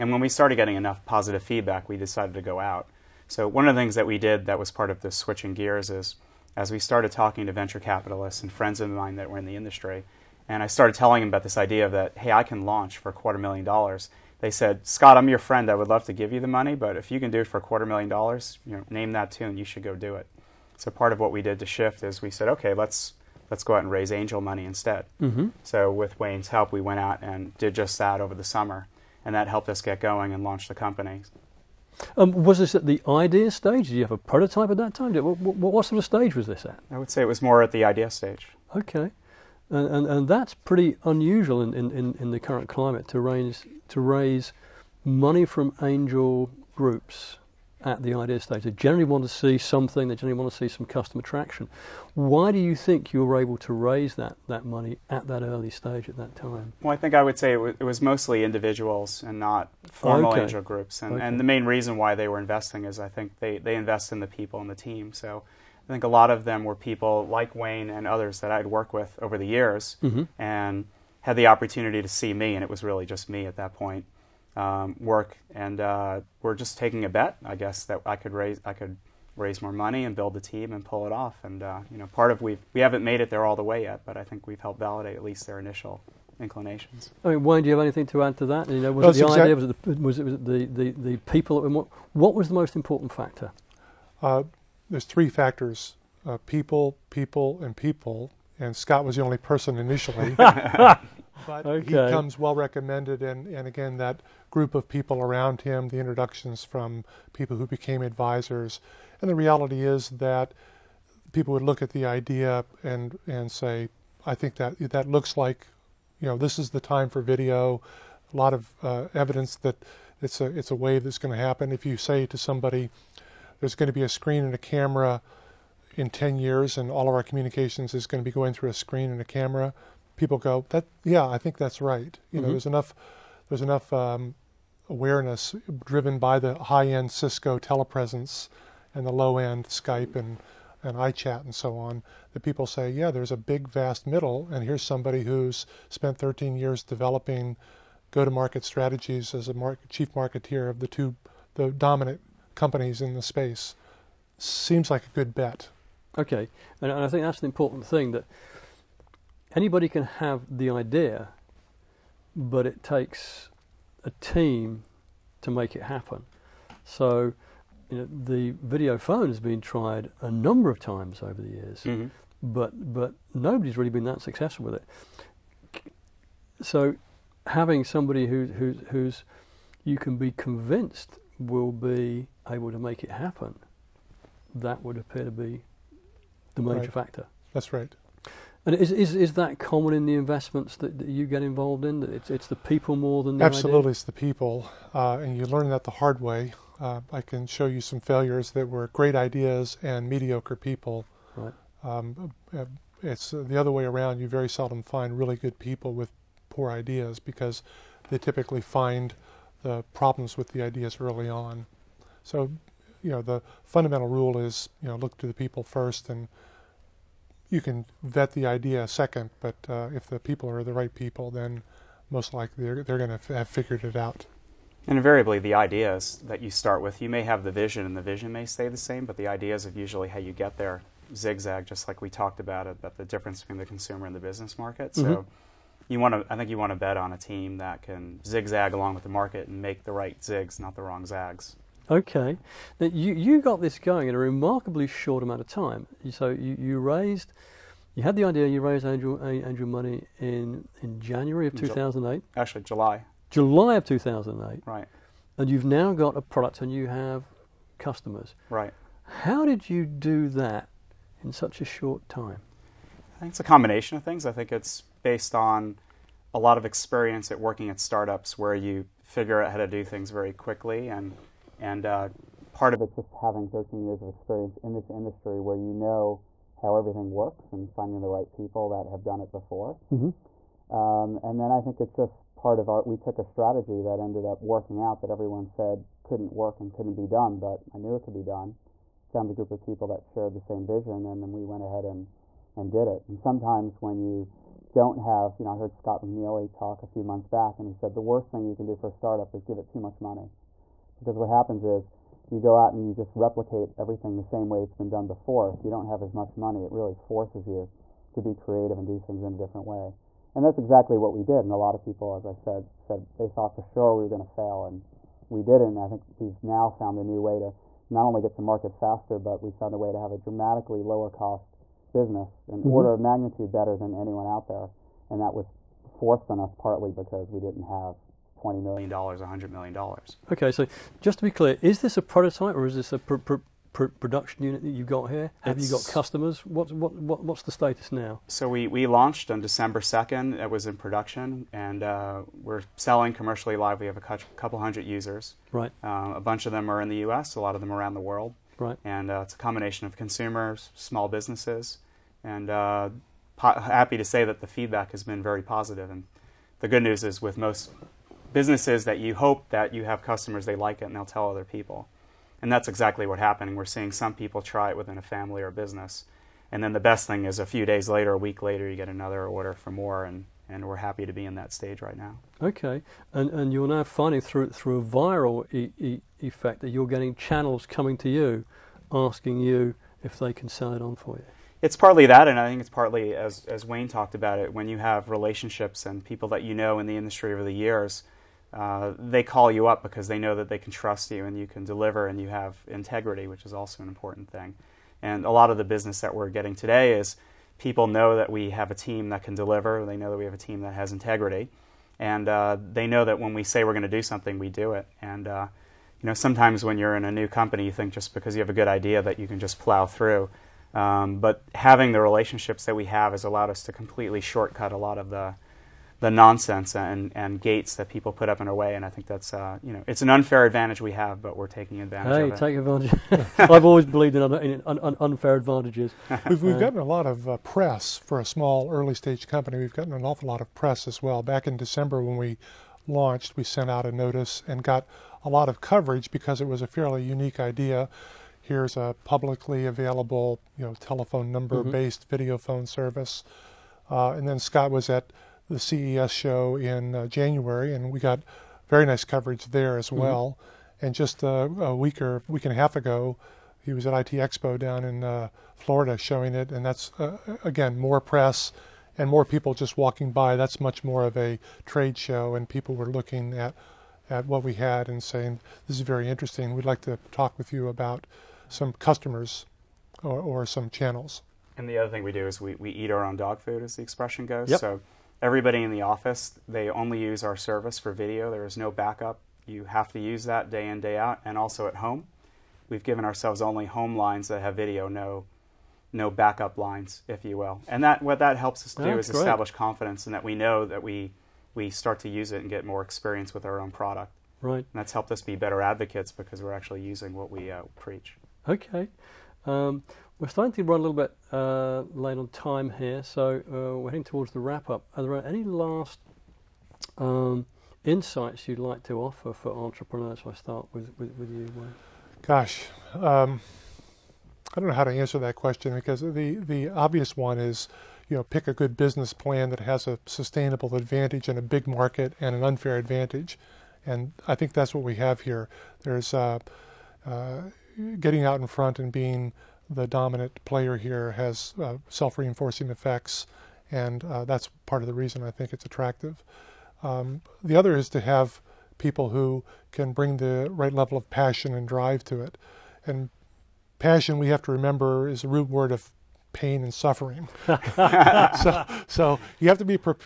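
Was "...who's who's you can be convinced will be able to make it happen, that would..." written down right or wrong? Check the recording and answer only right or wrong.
right.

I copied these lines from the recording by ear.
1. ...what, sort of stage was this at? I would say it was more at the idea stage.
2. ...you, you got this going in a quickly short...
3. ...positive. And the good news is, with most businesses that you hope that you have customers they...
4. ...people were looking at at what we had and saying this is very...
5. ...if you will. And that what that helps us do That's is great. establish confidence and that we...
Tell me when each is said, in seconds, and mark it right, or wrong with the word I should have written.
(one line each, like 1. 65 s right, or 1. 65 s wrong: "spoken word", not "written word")
1. 35 s right
2. 242 s wrong: "remarkably", not "quickly"
3. 355 s right
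4. 462 s right
5. 487 s right.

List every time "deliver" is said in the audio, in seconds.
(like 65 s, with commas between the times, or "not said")
391 s, 399 s.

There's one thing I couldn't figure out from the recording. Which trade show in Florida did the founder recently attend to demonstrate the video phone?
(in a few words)
IT Expo.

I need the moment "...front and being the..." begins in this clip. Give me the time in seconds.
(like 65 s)
528 s.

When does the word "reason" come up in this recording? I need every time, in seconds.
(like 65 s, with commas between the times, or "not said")
61 s, 534 s.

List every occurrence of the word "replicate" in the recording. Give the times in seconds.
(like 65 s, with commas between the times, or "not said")
303 s.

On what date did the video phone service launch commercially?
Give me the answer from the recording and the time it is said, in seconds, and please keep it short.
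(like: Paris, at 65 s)
December 2nd, at 339 s.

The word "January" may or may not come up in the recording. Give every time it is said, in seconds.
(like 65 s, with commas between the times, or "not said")
251 s, 447 s.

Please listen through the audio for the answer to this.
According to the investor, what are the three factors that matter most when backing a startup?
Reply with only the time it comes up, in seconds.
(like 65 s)
96 s.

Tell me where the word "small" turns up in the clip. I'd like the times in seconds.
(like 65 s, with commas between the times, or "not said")
350 s, 428 s.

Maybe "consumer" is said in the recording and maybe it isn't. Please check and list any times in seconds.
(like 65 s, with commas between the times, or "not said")
233 s, 349 s.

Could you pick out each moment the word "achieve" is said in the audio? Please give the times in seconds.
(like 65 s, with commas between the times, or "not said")
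not said.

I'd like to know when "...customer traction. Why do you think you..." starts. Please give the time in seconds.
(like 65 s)
50 s.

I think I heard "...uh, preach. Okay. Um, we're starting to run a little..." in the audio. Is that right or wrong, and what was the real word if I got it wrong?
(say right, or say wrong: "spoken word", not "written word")
right.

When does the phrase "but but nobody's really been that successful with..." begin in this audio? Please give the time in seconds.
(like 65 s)
172 s.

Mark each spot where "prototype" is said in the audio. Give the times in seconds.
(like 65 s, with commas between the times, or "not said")
34 s, 332 s.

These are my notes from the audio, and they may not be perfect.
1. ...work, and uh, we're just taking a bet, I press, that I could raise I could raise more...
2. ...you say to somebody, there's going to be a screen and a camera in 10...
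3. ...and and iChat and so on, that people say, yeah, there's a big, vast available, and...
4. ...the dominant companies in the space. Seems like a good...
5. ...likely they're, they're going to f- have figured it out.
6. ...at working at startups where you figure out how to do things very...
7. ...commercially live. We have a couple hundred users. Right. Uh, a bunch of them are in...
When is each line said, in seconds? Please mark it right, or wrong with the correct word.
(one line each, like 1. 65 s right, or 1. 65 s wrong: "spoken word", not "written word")
1. 75 s wrong: "guess", not "press"
2. 121 s right
3. 140 s wrong: "middle", not "available"
4. 151 s right
5. 222 s right
6. 267 s right
7. 343 s right.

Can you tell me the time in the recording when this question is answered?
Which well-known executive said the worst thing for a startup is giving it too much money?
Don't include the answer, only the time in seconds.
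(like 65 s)
295 s.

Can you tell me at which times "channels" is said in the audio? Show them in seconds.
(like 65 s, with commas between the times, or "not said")
377 s, 470 s.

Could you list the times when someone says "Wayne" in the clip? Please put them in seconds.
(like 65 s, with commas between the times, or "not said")
26 s, 67 s, 87 s, 383 s, 511 s.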